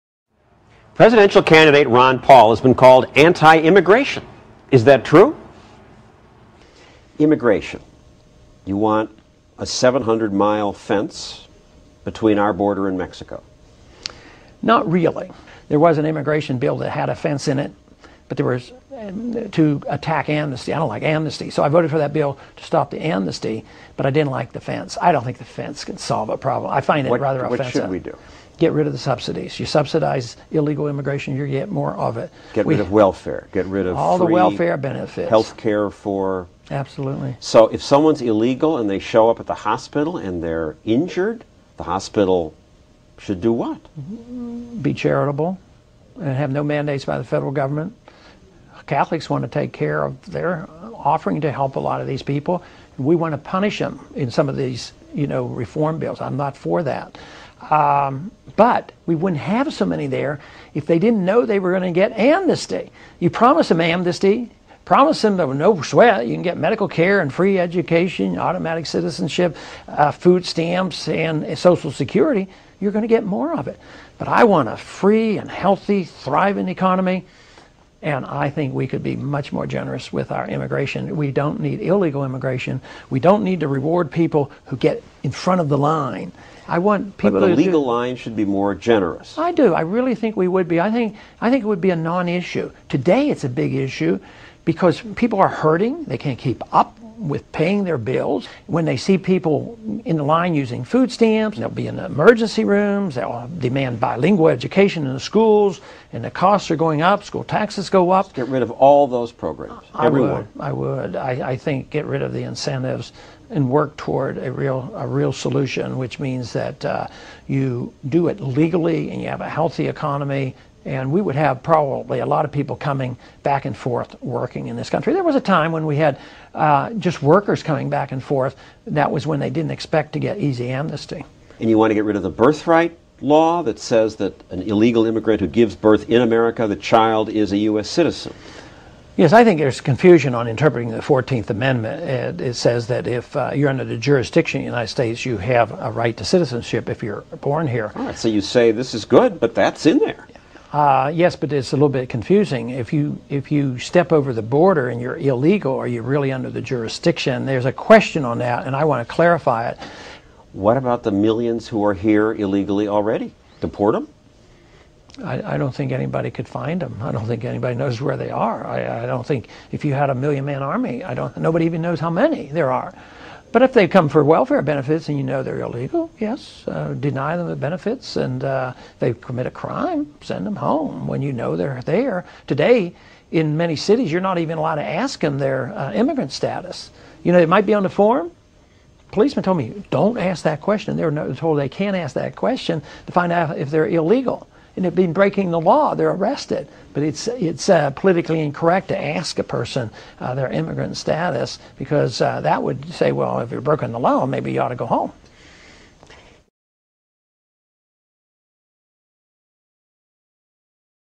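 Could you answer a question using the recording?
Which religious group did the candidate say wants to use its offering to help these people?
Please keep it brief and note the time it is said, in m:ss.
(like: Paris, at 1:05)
Catholics, at 0:48.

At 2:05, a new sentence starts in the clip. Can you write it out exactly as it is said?
There was a time when we had uh, just workers coming back and forth.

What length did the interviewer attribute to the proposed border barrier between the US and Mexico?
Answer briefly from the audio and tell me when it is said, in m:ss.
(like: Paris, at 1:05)
700 miles, at 0:09.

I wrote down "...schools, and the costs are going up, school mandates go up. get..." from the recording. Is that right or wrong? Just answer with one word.
wrong.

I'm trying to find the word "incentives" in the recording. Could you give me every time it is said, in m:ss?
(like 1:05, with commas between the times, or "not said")
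1:52.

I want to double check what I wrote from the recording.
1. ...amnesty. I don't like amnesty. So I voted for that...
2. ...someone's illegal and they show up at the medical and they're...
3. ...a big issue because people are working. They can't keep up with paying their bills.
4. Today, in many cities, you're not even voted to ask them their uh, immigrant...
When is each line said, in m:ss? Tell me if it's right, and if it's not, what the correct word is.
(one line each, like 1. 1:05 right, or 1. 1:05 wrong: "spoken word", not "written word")
1. 0:20 right
2. 0:37 wrong: "hospital", not "medical"
3. 1:33 wrong: "hurting", not "working"
4. 3:02 wrong: "allowed", not "voted".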